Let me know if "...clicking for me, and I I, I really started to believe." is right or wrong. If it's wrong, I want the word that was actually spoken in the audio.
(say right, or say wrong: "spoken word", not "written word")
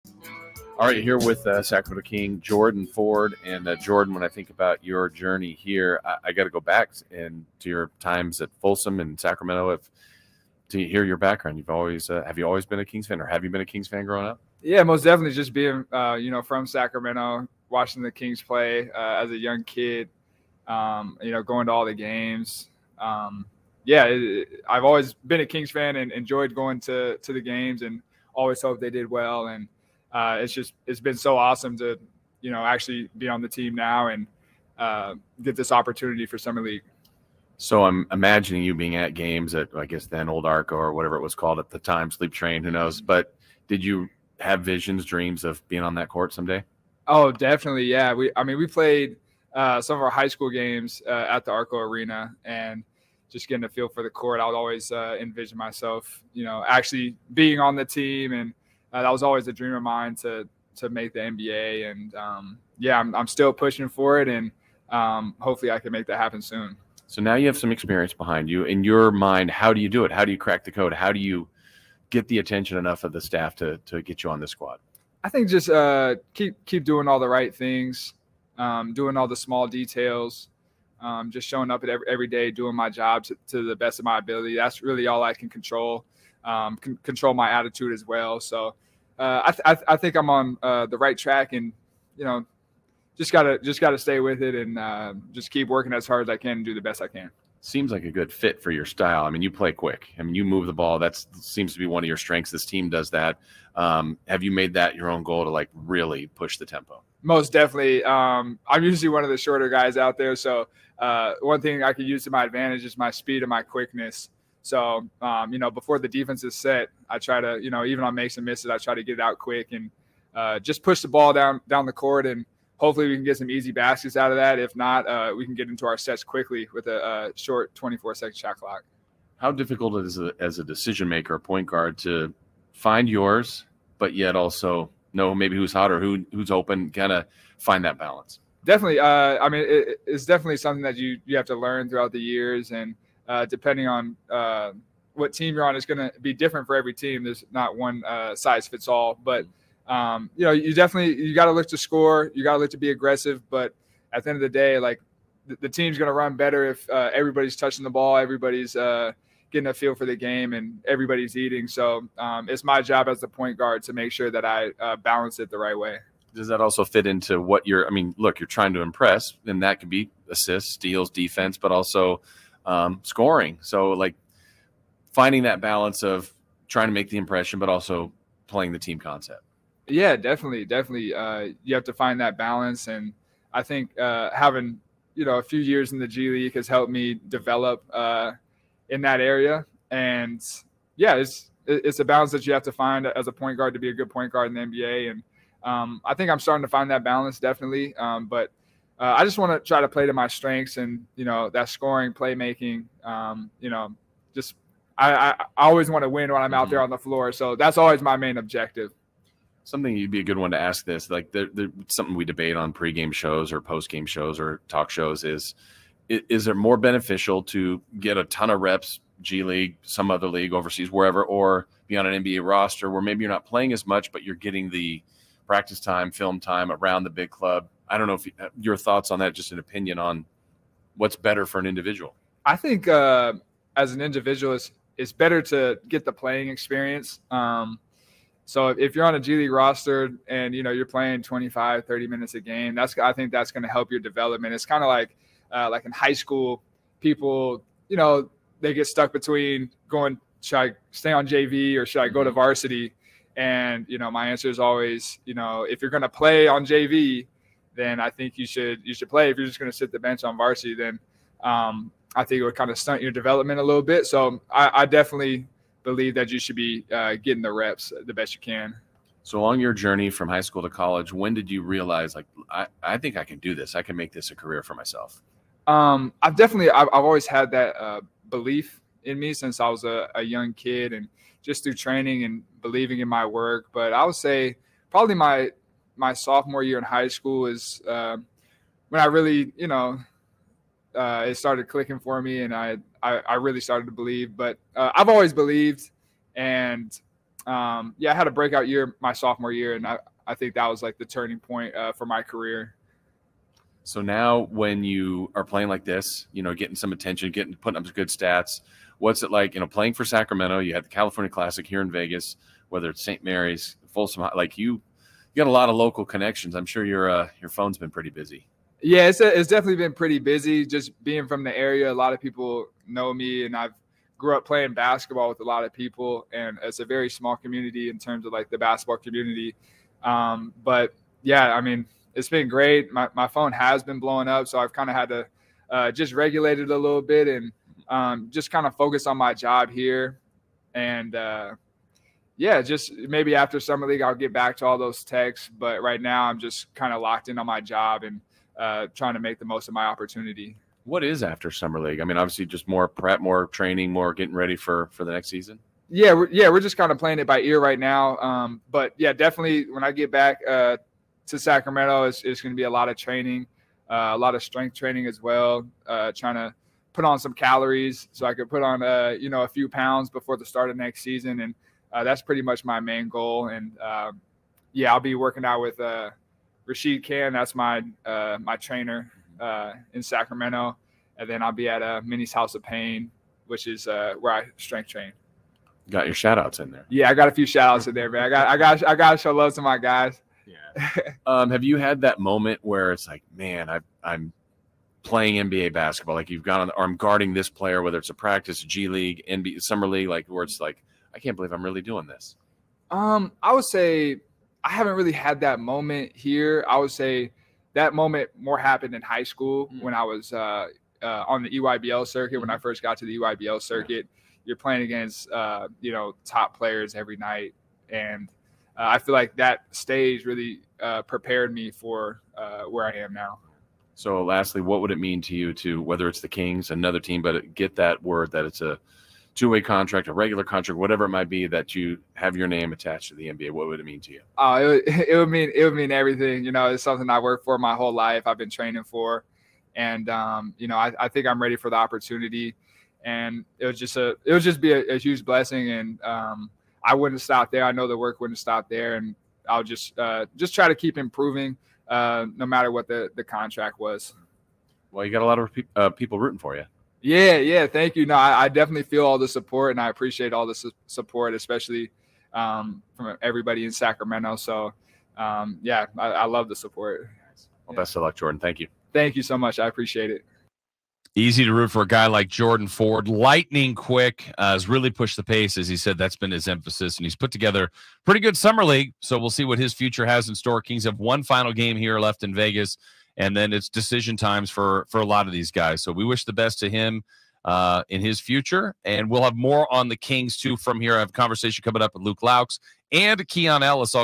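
right.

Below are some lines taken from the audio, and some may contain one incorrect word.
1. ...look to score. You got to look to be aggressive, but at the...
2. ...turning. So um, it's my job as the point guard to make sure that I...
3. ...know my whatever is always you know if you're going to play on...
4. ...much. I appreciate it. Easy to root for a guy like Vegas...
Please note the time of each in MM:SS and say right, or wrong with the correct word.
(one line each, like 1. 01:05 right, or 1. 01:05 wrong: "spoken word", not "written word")
1. 02:31 right
2. 02:41 wrong: "eating", not "turning"
3. 04:13 wrong: "answer", not "whatever"
4. 07:49 wrong: "Jordan", not "Vegas".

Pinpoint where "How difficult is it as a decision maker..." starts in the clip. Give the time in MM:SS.
02:09.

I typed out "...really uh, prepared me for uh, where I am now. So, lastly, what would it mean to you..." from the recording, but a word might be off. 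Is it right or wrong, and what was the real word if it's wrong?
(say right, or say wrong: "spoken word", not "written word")
right.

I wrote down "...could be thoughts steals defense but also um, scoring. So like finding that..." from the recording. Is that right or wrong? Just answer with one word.
wrong.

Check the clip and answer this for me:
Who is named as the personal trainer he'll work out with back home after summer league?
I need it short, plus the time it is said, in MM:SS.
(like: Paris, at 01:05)
Rashid Khan, at 06:16.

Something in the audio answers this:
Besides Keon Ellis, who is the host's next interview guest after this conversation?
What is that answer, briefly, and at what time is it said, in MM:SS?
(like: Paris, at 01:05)
Luke Loucks, at 08:12.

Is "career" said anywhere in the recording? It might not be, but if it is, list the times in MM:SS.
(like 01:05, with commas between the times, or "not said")
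04:34, 05:02.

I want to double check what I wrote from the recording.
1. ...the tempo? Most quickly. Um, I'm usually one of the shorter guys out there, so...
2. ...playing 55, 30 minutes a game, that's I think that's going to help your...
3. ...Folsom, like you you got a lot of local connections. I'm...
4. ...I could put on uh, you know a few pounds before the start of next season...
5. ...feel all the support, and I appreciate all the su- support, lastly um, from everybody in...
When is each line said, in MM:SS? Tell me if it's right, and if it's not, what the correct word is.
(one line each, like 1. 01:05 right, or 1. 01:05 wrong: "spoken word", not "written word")
1. 01:46 wrong: "definitely", not "quickly"
2. 04:00 wrong: "25", not "55"
3. 05:13 right
4. 06:08 right
5. 07:38 wrong: "especially", not "lastly".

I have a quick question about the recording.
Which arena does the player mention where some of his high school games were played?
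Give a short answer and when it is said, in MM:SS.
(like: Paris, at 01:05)
Arco Arena, at 00:51.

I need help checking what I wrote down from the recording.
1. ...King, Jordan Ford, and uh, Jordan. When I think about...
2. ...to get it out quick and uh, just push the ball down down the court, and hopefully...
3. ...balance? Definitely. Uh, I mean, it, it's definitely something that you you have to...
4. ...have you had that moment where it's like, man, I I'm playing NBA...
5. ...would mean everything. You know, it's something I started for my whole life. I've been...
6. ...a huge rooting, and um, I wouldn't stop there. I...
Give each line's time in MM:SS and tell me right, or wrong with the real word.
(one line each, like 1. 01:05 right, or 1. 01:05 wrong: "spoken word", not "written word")
1. 00:02 right
2. 01:58 right
3. 02:17 right
4. 06:31 right
5. 07:15 wrong: "worked", not "started"
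6. 07:24 wrong: "blessing", not "rooting".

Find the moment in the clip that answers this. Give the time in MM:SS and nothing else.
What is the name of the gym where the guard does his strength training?
06:22.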